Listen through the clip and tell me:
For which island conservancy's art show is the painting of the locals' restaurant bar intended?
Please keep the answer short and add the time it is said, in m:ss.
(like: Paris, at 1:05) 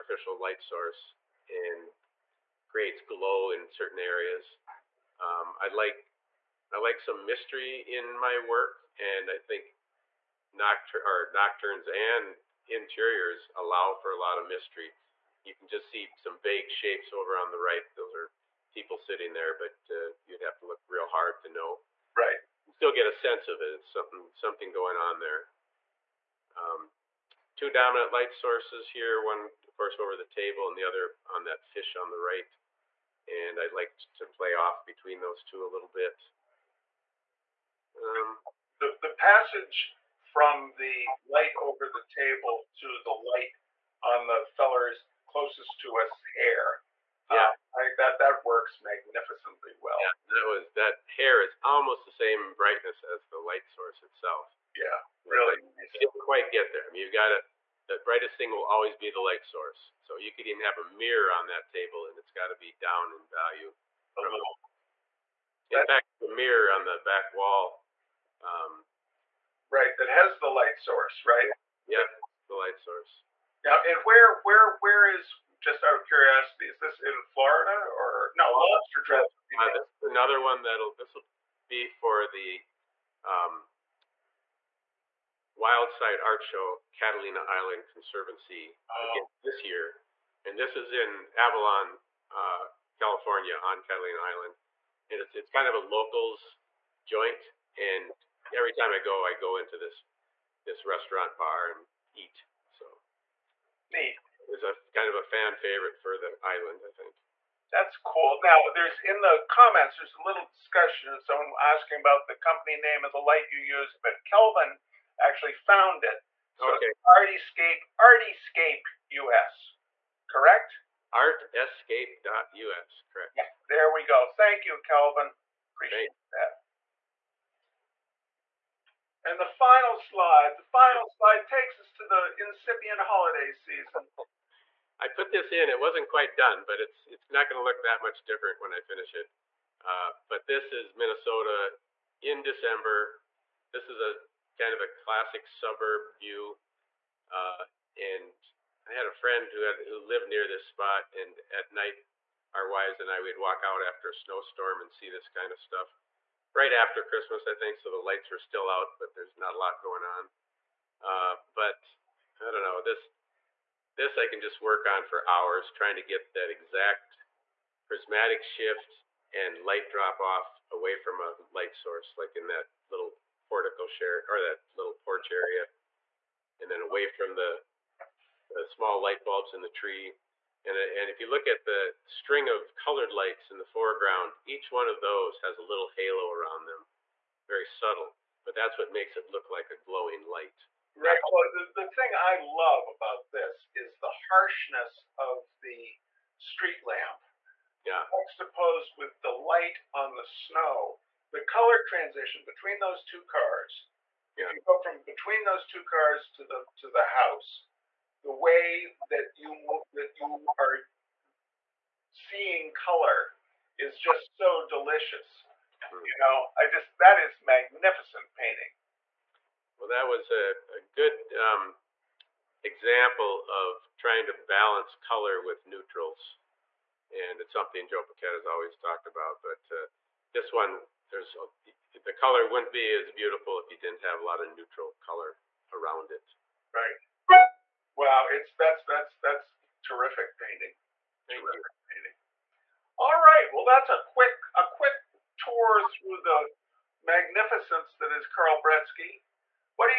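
Catalina Island Conservancy, at 1:26.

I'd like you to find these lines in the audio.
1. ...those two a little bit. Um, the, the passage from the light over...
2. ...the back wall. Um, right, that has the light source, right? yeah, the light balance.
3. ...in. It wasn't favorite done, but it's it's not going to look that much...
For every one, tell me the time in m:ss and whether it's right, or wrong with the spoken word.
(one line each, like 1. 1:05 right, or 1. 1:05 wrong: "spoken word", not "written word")
1. 0:35 right
2. 1:06 wrong: "source", not "balance"
3. 2:15 wrong: "quite", not "favorite".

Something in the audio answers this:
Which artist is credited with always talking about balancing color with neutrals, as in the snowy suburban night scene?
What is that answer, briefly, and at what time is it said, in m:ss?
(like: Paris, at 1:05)
Joe Paquette, at 3:47.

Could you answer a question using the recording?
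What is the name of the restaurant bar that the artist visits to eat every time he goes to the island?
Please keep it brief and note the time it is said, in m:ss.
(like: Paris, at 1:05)
Lobster Trap, at 1:18.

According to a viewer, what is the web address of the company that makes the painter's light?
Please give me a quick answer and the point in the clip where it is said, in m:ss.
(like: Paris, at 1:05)
artescape.us, at 2:01.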